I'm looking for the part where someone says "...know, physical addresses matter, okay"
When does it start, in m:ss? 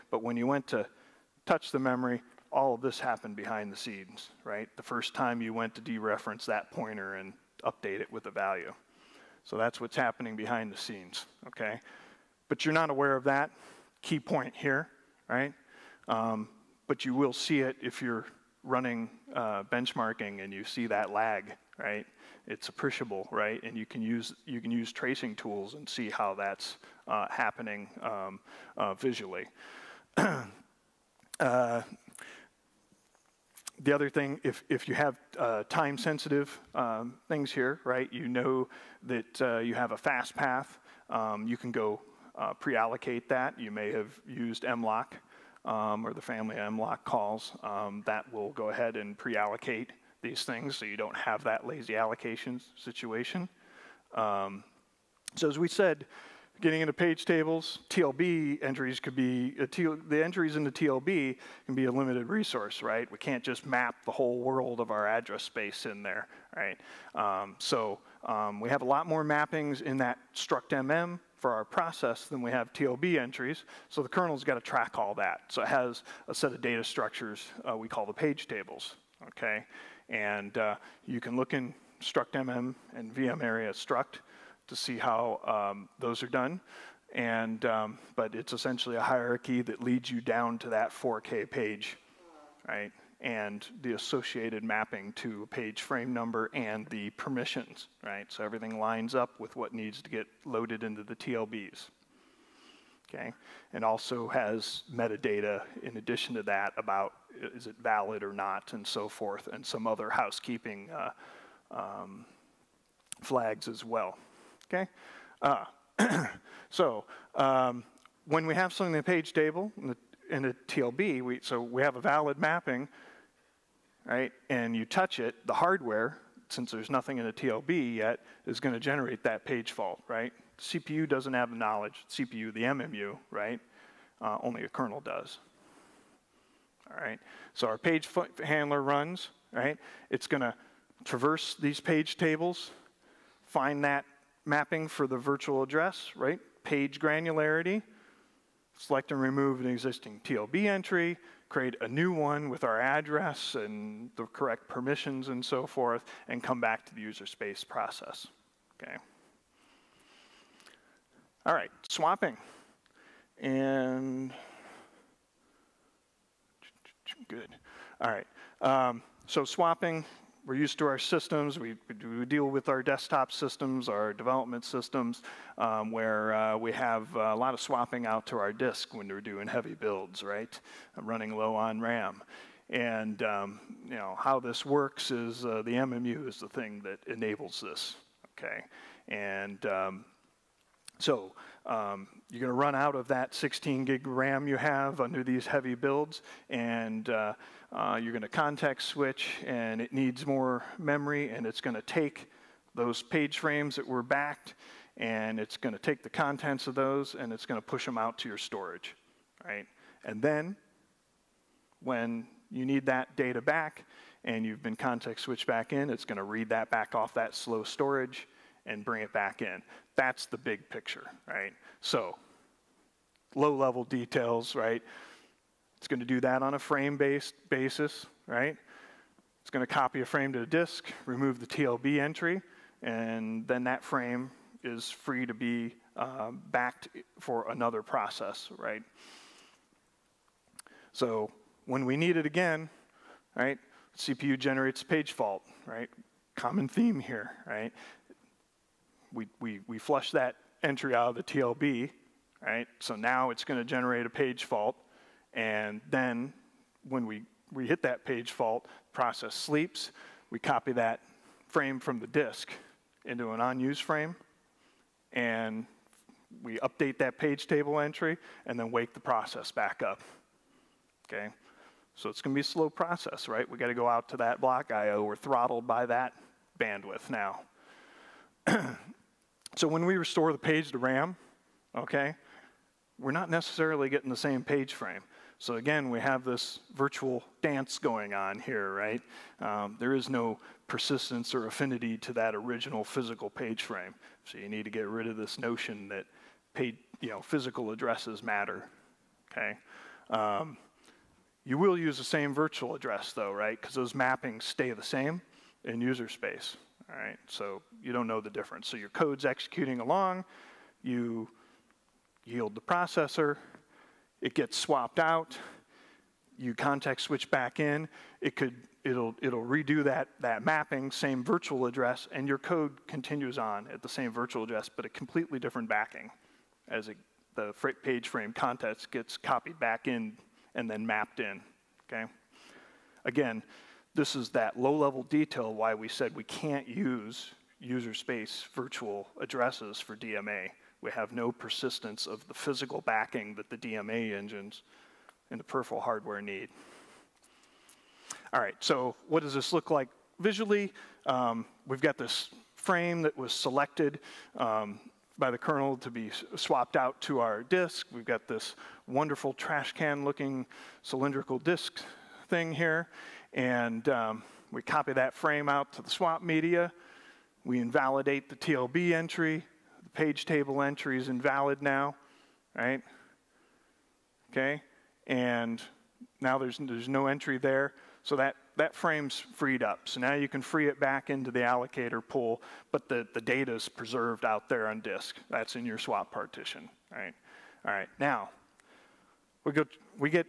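4:57.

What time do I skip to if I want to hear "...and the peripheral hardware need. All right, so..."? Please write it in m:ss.
5:45.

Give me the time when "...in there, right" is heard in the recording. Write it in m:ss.
1:05.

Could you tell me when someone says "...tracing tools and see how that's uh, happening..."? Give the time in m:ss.
0:24.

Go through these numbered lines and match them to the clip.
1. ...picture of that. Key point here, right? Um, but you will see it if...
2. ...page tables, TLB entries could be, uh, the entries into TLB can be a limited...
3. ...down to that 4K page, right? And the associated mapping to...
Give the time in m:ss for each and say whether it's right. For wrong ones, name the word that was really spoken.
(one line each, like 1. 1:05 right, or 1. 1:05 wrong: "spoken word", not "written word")
1. 0:12 wrong: "aware", not "picture"
2. 0:56 right
3. 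1:30 right.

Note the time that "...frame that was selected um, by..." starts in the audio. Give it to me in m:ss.
5:52.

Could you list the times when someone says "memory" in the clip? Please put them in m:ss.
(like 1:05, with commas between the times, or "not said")
0:01, 3:20.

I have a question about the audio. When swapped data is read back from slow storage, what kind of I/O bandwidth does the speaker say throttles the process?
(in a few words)
block I/O.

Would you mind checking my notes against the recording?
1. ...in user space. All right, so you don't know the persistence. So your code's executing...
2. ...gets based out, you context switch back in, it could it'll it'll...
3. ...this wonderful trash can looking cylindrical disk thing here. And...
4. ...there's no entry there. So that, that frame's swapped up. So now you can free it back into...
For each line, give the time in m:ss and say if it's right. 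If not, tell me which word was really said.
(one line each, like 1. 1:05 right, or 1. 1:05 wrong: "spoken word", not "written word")
1. 5:05 wrong: "difference", not "persistence"
2. 5:14 wrong: "swapped", not "based"
3. 5:58 right
4. 6:16 wrong: "freed", not "swapped".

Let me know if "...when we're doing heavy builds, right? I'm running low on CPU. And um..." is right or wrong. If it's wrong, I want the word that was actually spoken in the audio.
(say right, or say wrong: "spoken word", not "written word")
wrong: "RAM", not "CPU".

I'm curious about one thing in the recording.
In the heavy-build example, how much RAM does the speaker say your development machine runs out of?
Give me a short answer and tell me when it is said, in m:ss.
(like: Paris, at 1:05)
16 gig, at 3:13.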